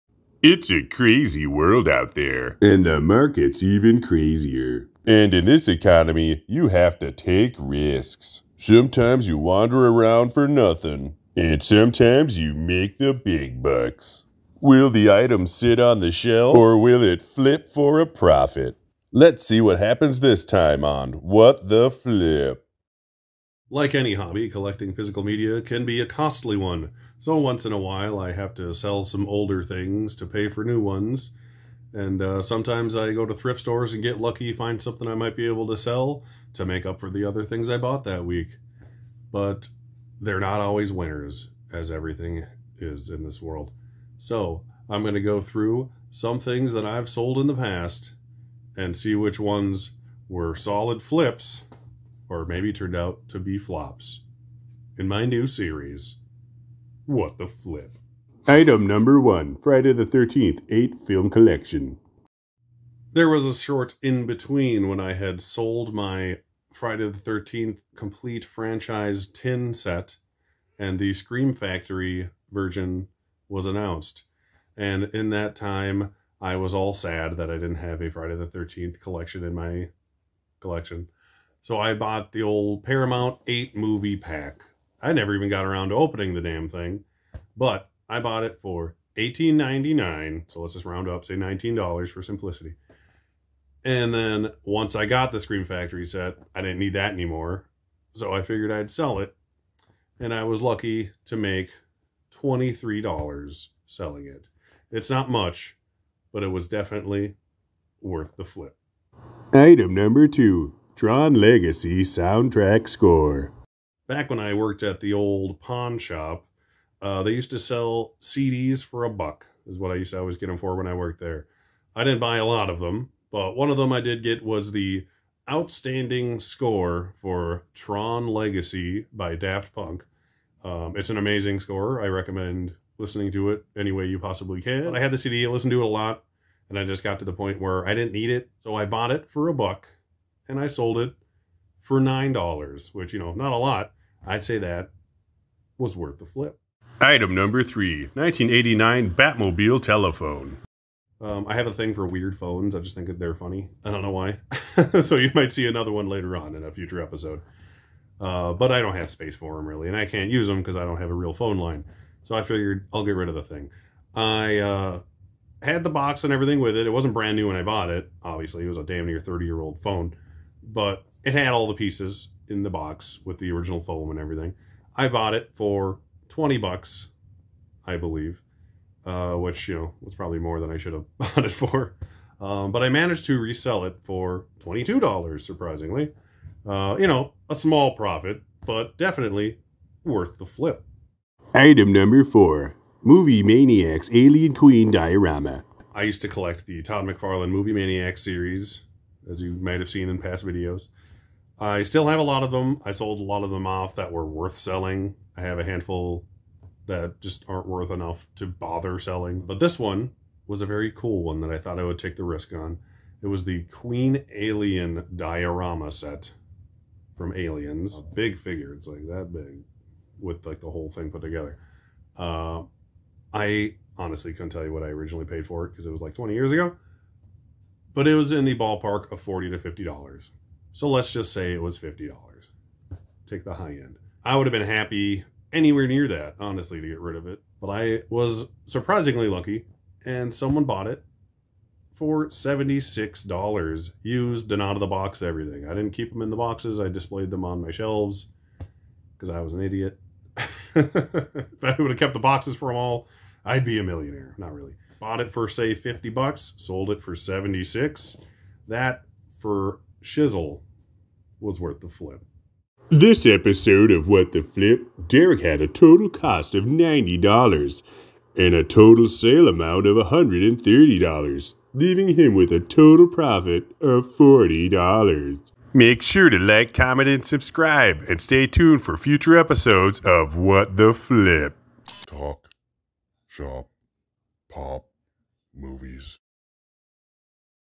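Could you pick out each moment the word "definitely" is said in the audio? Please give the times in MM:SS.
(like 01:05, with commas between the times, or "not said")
01:46, 03:08.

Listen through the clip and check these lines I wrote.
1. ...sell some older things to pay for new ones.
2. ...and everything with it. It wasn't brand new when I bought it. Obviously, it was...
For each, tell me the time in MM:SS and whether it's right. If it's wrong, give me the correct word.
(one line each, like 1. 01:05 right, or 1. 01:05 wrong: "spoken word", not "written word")
1. 00:28 right
2. 02:46 right.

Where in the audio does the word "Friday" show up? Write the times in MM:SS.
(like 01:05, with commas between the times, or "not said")
00:59, 01:06, 01:18.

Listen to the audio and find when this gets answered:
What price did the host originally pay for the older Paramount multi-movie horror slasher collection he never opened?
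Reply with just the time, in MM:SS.
01:29.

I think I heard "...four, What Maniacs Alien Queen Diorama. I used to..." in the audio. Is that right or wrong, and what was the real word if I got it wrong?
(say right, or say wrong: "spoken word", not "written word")
wrong: "Movie", not "What".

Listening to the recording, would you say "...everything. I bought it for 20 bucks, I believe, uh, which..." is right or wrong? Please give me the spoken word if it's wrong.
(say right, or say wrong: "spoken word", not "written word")
right.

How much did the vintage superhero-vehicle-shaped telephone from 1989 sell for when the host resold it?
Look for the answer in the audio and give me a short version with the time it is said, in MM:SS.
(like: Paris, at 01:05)
$22, at 03:04.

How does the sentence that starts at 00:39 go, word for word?
But they're not always winners, as everything is in this world.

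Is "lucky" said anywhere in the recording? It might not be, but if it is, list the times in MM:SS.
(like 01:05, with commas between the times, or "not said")
00:34, 01:40, 03:59.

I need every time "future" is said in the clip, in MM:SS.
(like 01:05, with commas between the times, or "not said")
02:36, 04:38.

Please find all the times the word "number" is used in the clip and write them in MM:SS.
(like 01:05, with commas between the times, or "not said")
00:58, 01:49, 02:27, 03:11.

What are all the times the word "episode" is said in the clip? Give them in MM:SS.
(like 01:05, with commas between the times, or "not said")
02:37, 04:23, 04:39.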